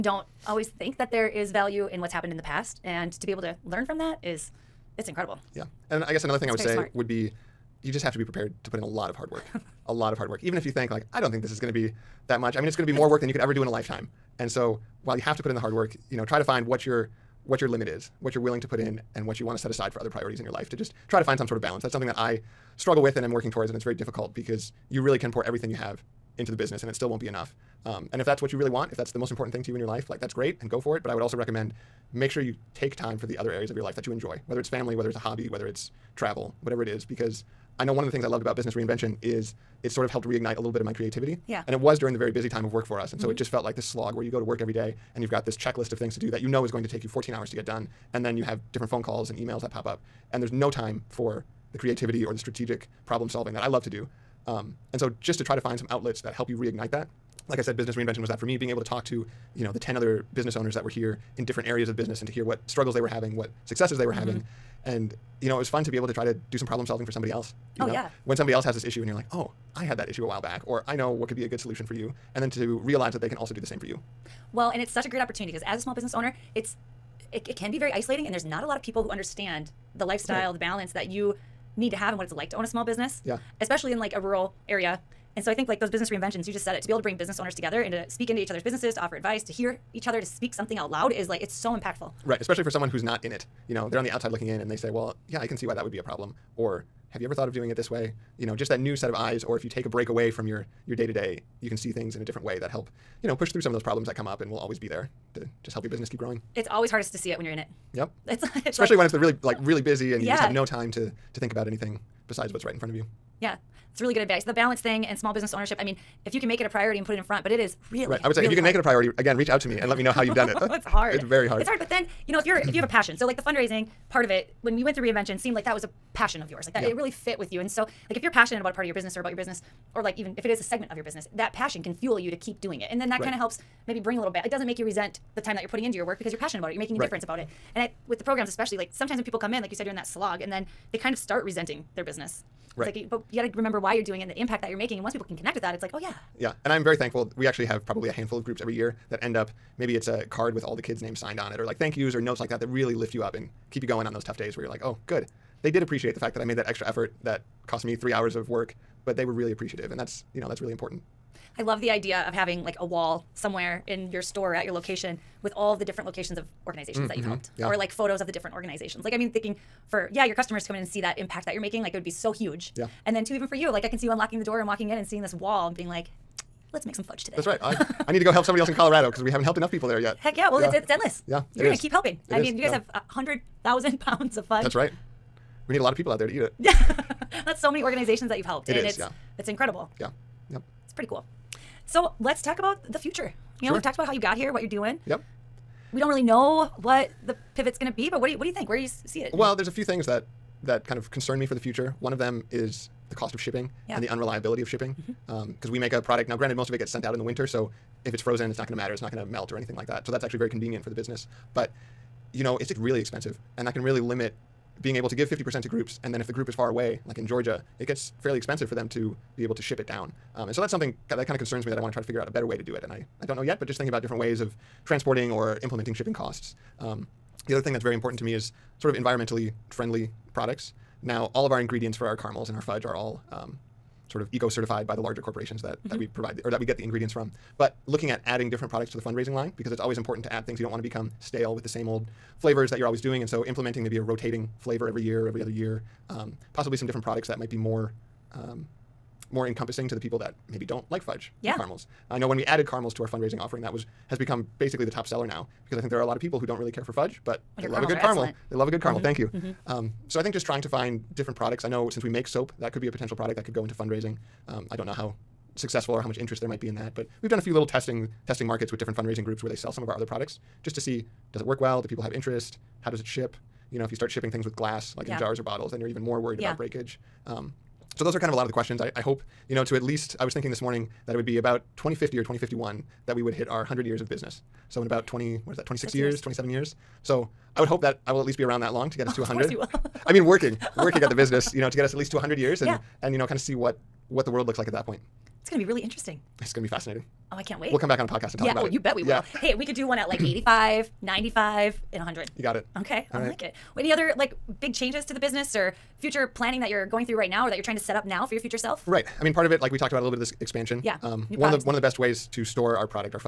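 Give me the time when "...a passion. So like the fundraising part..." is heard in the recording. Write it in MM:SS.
02:02.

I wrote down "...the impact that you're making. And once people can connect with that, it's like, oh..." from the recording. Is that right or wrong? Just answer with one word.
right.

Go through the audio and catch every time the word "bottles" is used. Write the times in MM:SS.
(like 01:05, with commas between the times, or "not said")
04:35.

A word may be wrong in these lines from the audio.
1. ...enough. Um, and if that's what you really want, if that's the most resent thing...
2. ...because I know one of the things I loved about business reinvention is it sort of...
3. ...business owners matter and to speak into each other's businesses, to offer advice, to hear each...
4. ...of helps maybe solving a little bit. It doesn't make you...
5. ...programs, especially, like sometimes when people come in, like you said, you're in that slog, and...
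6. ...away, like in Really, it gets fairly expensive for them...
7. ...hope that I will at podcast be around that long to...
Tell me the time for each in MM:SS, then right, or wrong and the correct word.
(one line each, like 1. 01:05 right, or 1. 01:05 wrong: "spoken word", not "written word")
1. 00:27 wrong: "important", not "resent"
2. 00:37 right
3. 01:27 wrong: "together", not "matter"
4. 02:13 wrong: "bring", not "solving"
5. 02:18 right
6. 03:36 wrong: "Georgia", not "Really"
7. 04:47 wrong: "least", not "podcast".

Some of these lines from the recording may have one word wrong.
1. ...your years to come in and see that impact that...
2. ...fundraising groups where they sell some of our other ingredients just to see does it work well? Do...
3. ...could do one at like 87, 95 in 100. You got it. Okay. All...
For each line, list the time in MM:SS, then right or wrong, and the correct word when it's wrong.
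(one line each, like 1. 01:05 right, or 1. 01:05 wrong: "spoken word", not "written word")
1. 02:50 wrong: "customers", not "years"
2. 04:28 wrong: "products", not "ingredients"
3. 04:59 wrong: "85", not "87".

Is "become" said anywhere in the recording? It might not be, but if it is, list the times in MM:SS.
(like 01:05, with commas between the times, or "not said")
04:00, 04:14.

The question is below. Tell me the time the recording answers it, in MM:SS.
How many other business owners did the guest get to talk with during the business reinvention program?
00:59.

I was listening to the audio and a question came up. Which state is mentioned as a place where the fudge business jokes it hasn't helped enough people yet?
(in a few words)
Colorado.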